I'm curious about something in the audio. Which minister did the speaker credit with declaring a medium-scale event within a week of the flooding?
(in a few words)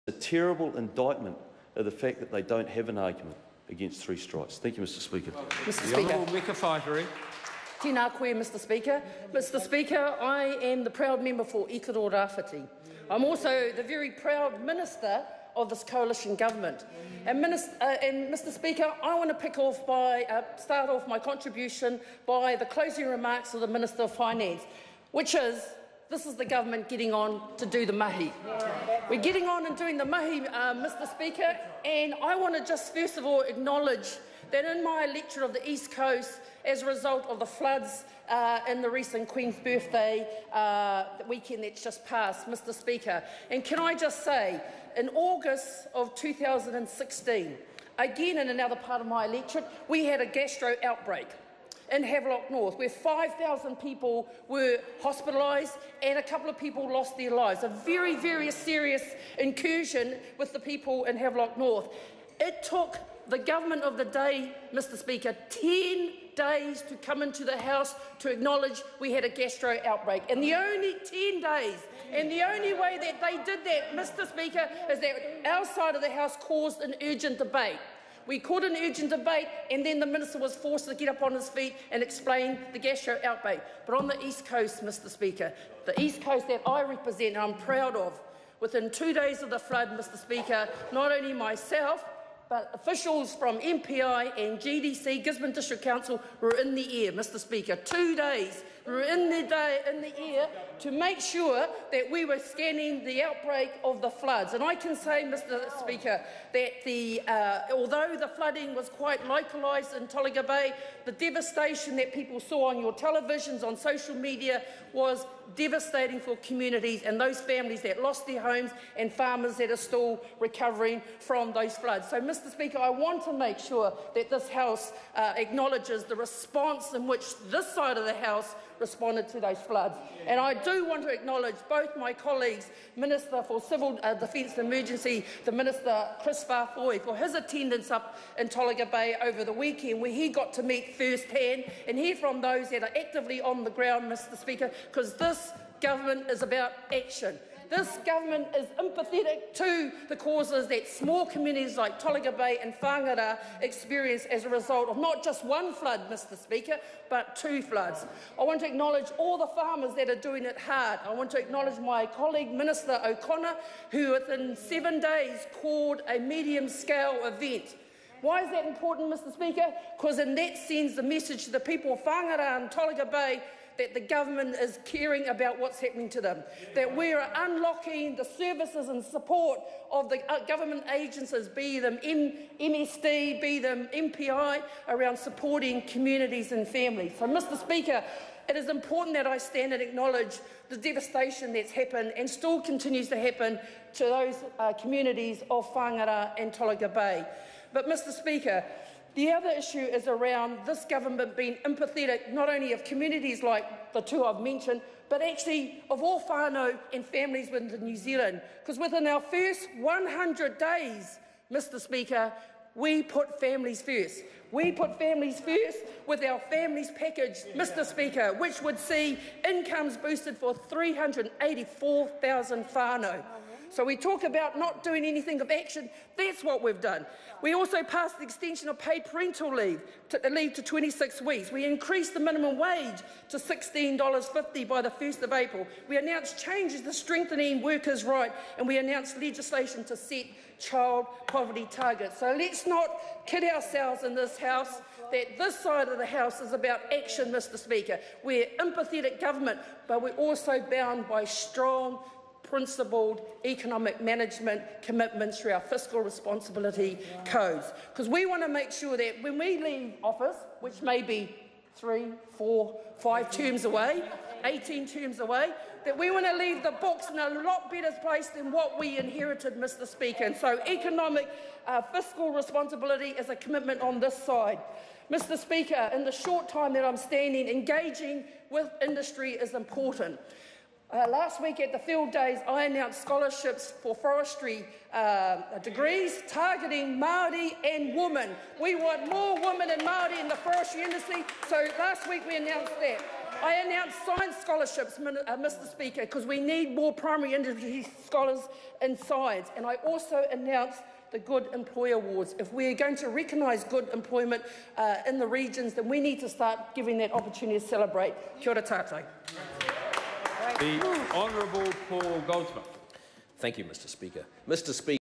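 Minister O'Connor.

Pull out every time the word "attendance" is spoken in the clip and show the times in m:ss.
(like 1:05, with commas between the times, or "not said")
2:17.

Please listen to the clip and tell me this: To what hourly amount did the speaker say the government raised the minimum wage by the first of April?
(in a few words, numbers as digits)
$16.50.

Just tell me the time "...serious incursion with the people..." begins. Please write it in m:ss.
0:58.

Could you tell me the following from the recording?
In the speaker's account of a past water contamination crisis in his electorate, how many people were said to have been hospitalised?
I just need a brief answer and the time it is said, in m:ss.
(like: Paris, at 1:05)
5,000, at 0:52.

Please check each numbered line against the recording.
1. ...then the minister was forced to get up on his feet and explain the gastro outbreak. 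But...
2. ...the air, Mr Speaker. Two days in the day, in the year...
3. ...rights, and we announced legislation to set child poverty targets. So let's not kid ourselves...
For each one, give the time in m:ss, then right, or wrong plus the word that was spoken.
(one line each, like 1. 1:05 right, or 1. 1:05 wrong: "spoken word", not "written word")
1. 1:19 right
2. 1:36 right
3. 3:58 right.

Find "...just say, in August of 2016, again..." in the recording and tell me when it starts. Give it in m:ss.
0:43.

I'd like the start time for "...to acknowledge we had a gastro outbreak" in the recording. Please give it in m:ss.
1:08.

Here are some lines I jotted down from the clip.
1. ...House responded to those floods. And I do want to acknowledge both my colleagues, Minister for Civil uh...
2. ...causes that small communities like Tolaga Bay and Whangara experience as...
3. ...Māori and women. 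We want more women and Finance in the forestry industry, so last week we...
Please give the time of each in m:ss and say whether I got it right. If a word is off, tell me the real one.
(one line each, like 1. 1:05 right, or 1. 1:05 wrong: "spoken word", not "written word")
1. 2:08 right
2. 2:30 right
3. 4:46 wrong: "Māori", not "Finance".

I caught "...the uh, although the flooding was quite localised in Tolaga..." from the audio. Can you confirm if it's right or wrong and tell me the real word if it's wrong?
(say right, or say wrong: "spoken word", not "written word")
right.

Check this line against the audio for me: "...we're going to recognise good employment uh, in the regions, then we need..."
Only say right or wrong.
right.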